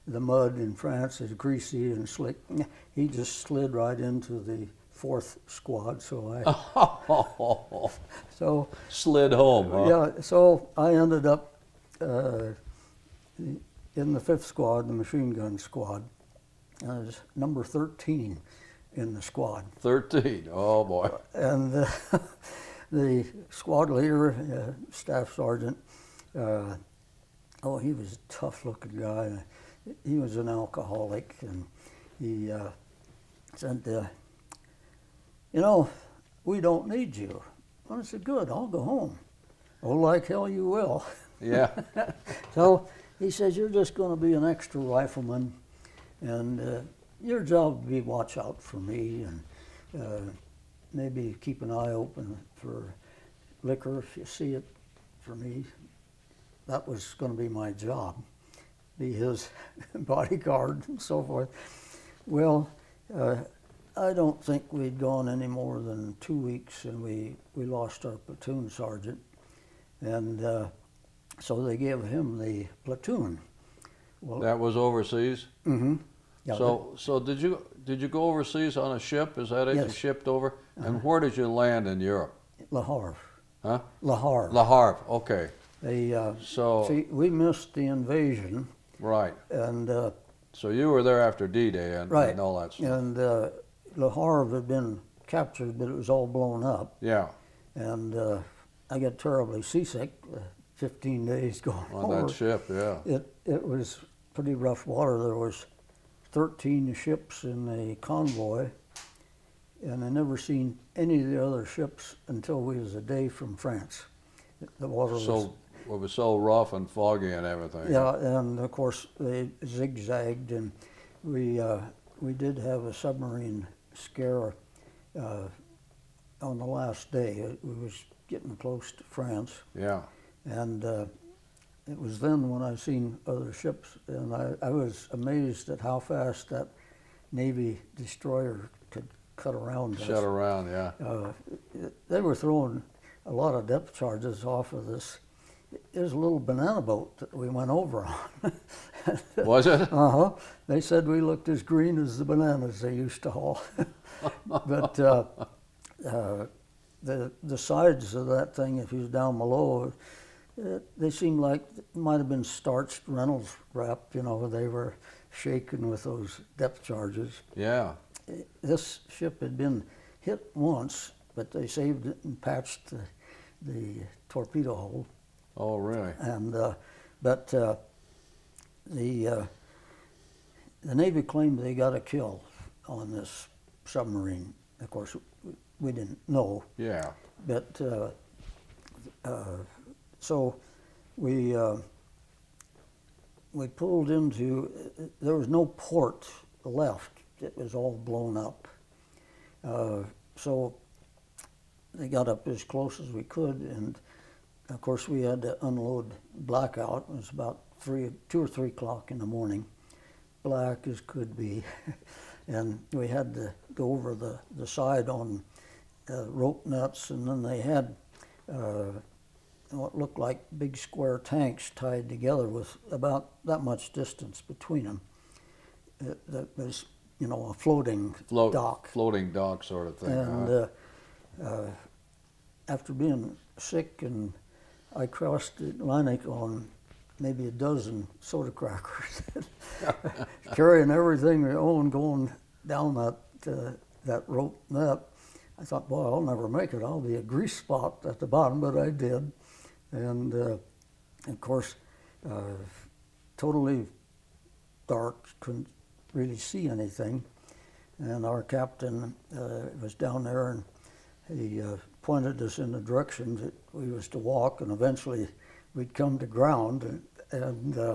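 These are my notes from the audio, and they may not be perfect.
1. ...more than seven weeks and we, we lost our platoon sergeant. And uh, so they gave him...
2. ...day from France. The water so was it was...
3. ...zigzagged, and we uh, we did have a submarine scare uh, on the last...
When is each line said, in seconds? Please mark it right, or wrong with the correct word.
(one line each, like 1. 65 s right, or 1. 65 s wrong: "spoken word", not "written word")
1. 65 s wrong: "two", not "seven"
2. 112 s right
3. 119 s right.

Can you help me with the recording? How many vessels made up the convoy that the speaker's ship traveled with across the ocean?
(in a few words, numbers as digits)
13.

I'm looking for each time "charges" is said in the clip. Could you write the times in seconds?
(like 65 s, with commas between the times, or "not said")
143 s, 166 s.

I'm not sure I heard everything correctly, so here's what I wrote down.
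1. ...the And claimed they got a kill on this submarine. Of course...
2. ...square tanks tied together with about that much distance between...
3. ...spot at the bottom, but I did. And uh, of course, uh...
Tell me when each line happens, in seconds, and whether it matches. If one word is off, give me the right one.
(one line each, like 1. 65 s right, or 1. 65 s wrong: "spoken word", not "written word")
1. 180 s wrong: "Navy", not "And"
2. 220 s right
3. 247 s right.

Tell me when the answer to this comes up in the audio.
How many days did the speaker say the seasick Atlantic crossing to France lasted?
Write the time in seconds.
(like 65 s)
100 s.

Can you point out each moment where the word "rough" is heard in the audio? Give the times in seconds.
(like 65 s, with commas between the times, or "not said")
104 s, 116 s.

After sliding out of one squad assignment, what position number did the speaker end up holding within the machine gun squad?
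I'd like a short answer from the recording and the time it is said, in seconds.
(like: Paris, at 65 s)
13, at 17 s.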